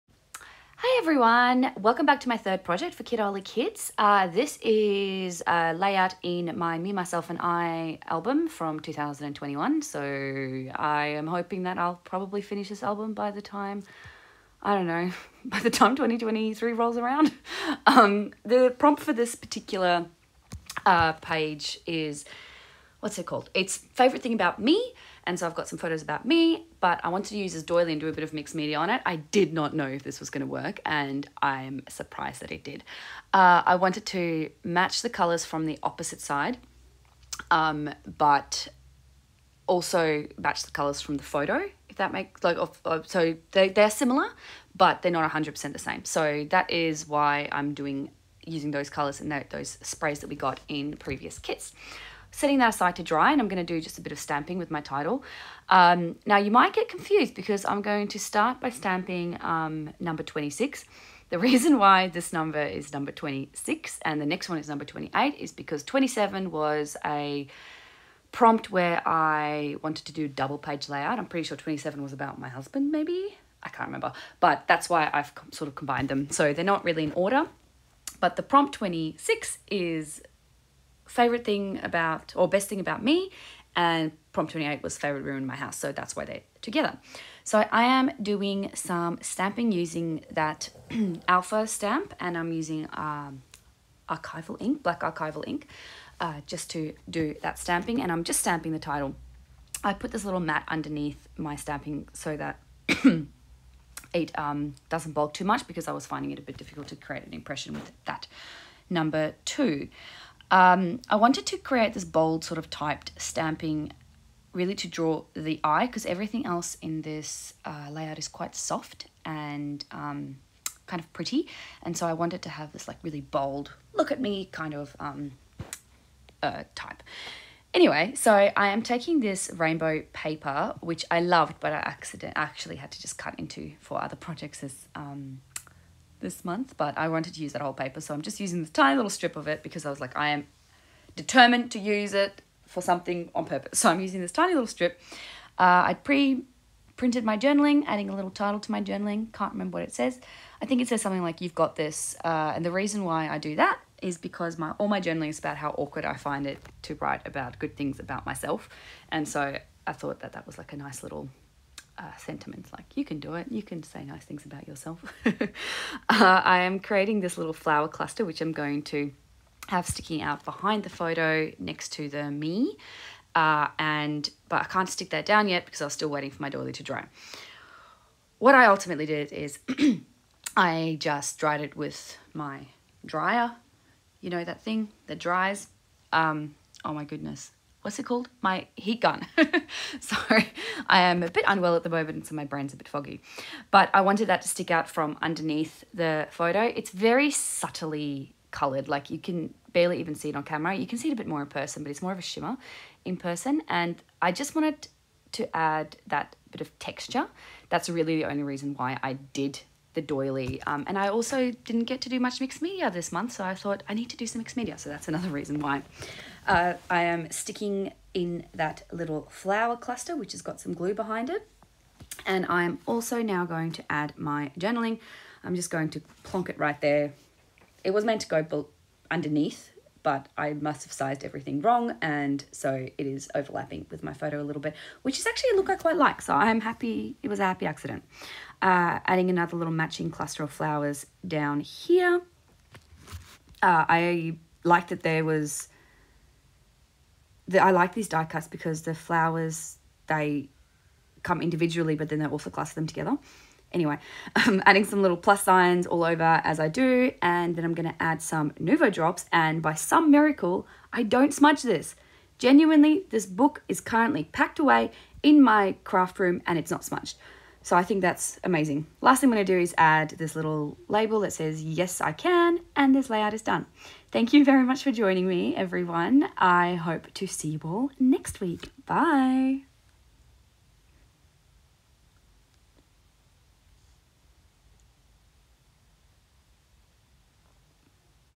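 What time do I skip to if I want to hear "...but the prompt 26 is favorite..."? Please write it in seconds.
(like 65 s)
78 s.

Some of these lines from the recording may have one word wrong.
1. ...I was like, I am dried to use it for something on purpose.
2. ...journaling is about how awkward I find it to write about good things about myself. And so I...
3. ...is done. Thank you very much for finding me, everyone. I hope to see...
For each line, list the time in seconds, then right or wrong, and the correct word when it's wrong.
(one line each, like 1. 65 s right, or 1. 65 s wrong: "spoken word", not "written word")
1. 139 s wrong: "determined", not "dried"
2. 155 s right
3. 273 s wrong: "joining", not "finding".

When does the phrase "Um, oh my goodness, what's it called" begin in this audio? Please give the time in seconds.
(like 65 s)
186 s.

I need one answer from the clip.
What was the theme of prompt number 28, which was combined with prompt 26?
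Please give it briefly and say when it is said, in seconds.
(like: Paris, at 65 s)
Favorite room in my house, at 84 s.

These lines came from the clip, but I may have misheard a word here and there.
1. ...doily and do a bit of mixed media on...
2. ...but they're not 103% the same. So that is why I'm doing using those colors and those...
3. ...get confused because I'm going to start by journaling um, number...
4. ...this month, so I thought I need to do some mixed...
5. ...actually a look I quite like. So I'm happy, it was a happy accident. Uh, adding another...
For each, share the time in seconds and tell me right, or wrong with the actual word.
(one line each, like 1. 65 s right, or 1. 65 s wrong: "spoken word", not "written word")
1. 27 s right
2. 44 s wrong: "100", not "103"
3. 56 s wrong: "stamping", not "journaling"
4. 212 s right
5. 235 s right.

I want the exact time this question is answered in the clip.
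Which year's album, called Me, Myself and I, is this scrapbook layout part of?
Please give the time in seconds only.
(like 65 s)
8 s.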